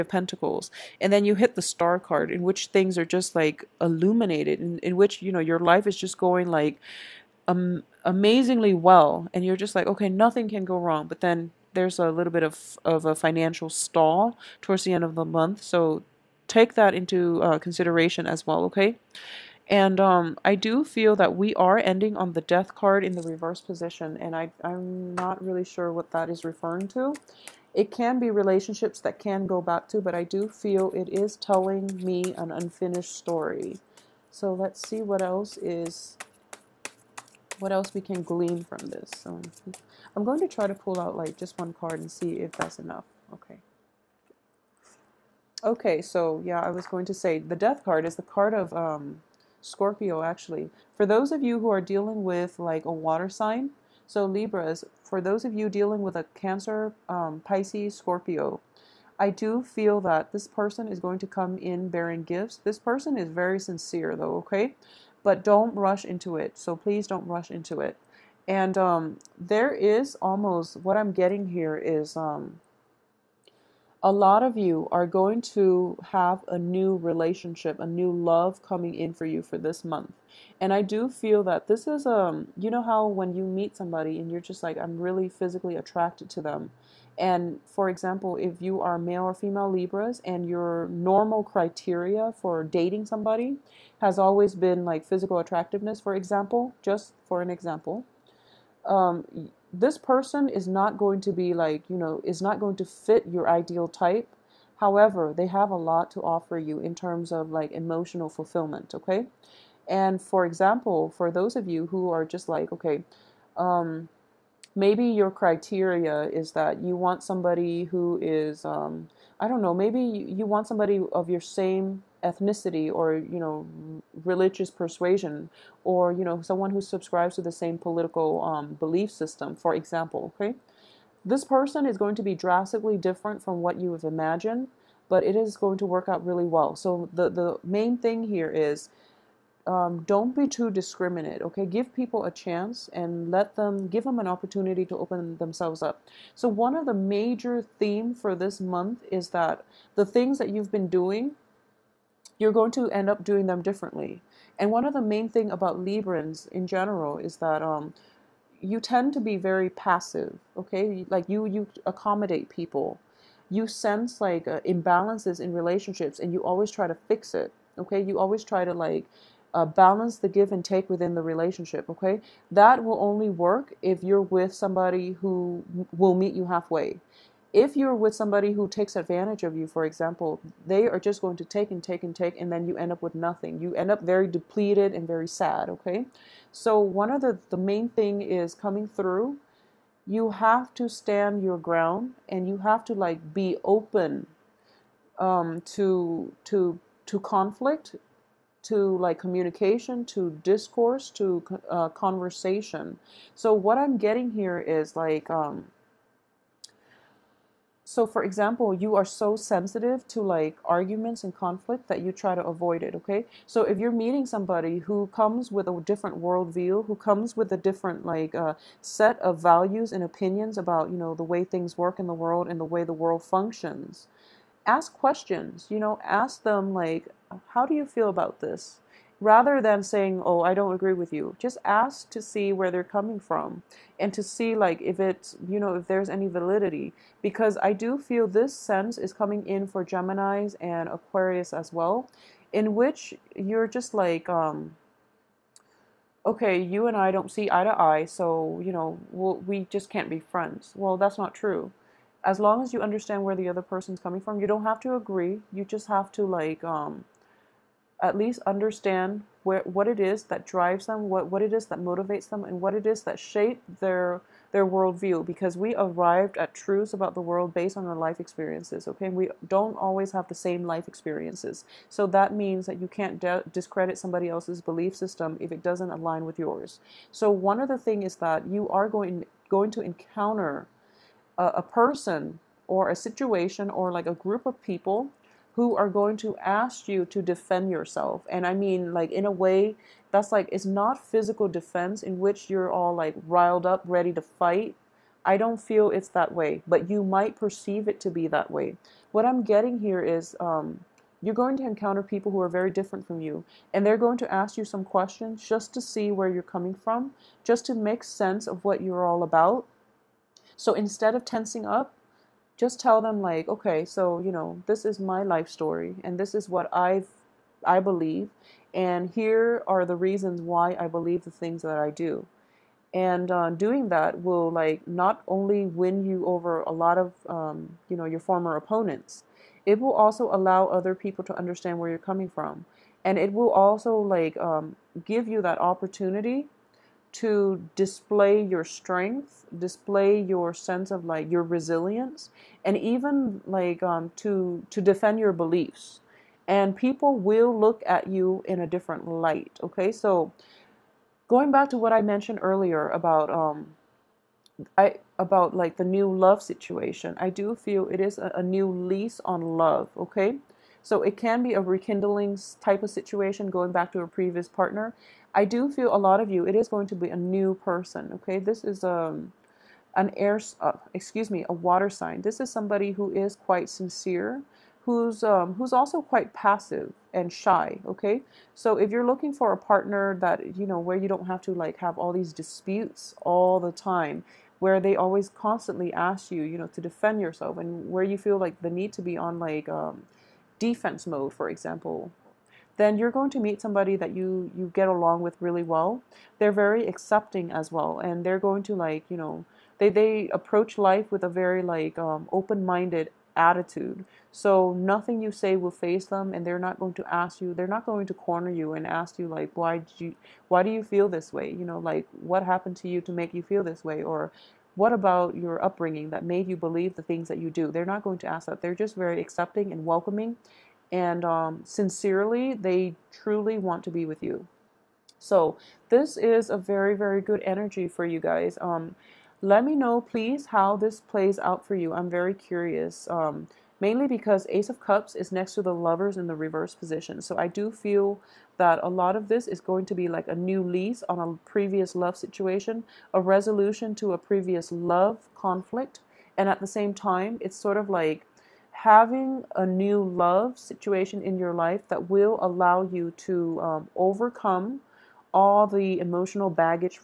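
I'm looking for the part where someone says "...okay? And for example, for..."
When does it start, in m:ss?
1:48.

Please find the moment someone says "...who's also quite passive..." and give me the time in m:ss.
6:15.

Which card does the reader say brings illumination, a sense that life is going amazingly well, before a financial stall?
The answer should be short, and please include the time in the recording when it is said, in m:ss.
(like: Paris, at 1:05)
The Star, at 0:01.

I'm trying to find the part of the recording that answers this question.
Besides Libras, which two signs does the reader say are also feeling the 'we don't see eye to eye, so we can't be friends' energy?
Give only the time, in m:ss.
3:59.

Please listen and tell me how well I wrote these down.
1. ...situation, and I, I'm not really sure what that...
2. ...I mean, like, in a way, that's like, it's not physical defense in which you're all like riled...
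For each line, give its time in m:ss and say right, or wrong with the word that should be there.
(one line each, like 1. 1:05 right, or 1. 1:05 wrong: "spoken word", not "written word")
1. 0:23 wrong: "position", not "situation"
2. 4:48 right.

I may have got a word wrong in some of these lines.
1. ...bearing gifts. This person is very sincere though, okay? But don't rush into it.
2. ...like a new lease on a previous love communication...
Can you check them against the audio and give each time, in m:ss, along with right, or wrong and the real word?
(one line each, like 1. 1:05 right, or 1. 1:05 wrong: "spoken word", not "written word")
1. 1:01 right
2. 7:20 wrong: "situation", not "communication".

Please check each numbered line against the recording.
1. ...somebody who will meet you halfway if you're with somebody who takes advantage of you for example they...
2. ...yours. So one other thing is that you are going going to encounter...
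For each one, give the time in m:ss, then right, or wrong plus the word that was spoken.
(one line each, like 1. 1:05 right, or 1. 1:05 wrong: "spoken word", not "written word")
1. 2:54 right
2. 4:36 right.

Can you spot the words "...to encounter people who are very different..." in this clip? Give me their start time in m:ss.
5:01.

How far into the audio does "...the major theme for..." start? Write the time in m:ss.
2:26.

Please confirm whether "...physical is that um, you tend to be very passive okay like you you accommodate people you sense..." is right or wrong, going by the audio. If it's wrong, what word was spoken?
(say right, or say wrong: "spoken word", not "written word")
wrong: "general", not "physical".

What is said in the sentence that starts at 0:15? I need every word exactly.
So take that into uh, consideration as well, okay?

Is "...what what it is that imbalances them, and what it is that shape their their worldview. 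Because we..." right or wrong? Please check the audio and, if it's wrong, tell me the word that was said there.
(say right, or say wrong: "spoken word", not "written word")
wrong: "motivates", not "imbalances".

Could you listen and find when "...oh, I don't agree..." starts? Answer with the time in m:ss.
3:50.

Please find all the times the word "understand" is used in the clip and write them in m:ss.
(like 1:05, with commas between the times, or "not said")
4:12, 4:18, 5:31.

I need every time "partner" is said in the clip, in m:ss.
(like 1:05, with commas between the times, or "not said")
6:04, 6:19.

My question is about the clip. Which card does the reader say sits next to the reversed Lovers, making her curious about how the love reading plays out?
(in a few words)
Ace of Cups.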